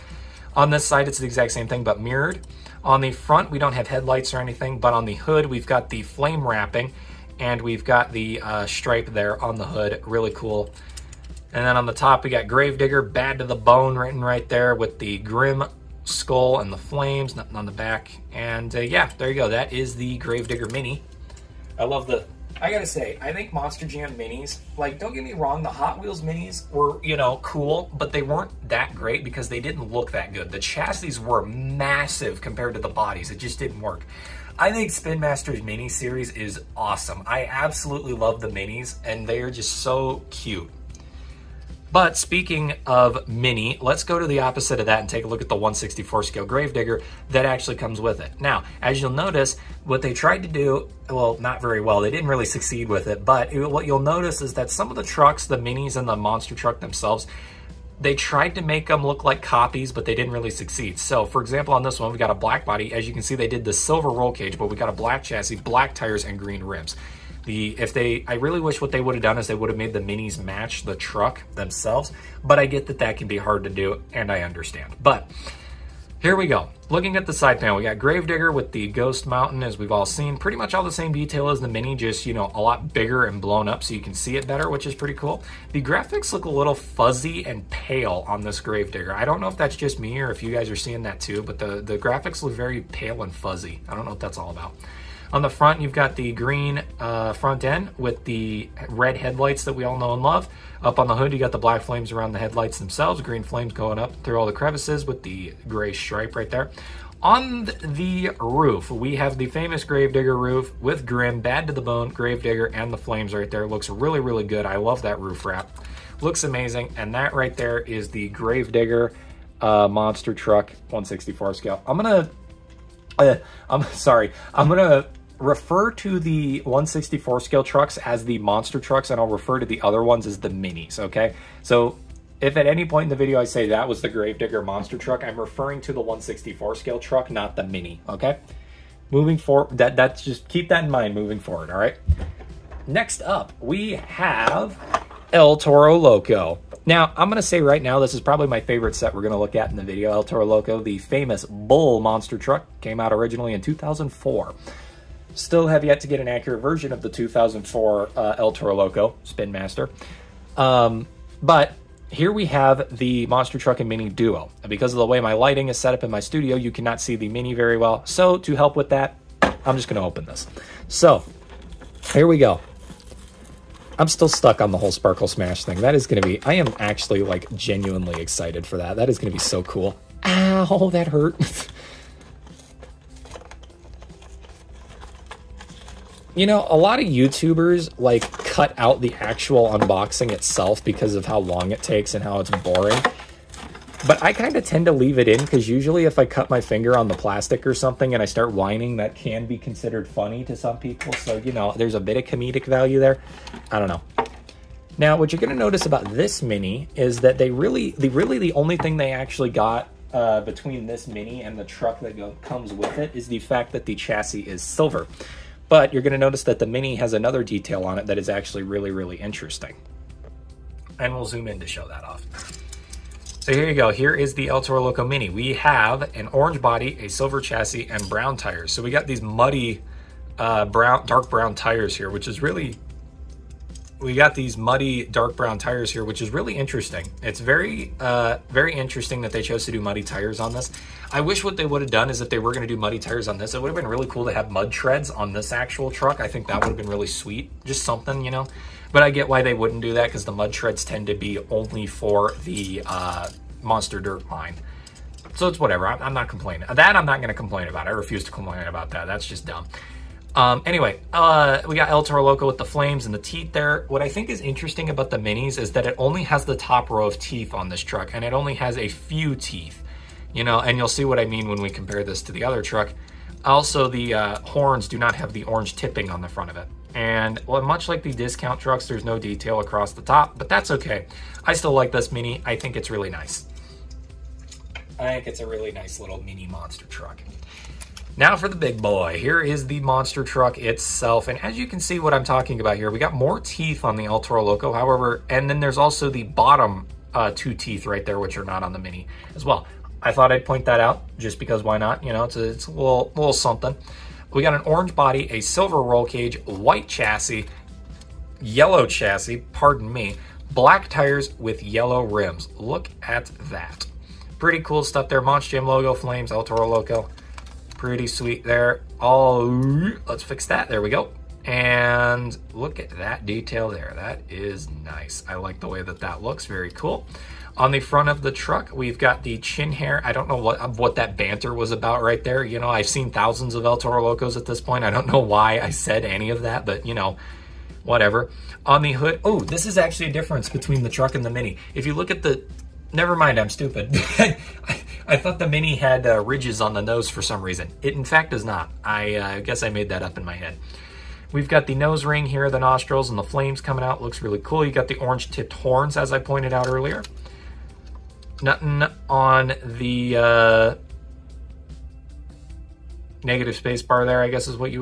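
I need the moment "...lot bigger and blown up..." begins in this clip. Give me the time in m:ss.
1:22.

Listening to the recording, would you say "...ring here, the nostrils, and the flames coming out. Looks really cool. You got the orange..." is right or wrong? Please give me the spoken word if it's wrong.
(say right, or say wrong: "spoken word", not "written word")
right.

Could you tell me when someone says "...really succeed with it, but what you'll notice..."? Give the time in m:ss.
0:52.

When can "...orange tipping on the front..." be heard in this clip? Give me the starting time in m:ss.
4:35.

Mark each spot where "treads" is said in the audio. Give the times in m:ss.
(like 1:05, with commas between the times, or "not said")
4:04, 4:10.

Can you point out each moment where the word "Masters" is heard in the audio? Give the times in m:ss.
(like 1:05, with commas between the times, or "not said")
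0:35, 2:39.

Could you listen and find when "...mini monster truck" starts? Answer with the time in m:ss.
4:46.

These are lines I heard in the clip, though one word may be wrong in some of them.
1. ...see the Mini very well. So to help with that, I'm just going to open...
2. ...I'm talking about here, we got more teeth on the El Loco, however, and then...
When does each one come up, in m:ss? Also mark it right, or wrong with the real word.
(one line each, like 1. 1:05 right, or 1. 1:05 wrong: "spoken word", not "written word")
1. 2:47 right
2. 4:52 right.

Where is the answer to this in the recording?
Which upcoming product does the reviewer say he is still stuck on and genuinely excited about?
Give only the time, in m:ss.
2:54.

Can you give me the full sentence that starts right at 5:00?
I thought I'd point that out just because why not?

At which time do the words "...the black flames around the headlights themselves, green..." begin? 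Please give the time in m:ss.
1:41.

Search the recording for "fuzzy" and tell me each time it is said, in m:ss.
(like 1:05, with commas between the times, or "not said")
1:26, 1:33.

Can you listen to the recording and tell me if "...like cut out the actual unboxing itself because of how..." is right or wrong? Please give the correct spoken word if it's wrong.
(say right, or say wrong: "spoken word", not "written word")
right.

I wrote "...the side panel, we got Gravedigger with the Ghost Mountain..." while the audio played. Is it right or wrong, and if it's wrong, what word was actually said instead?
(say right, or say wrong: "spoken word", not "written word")
right.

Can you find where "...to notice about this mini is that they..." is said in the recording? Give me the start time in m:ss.
3:25.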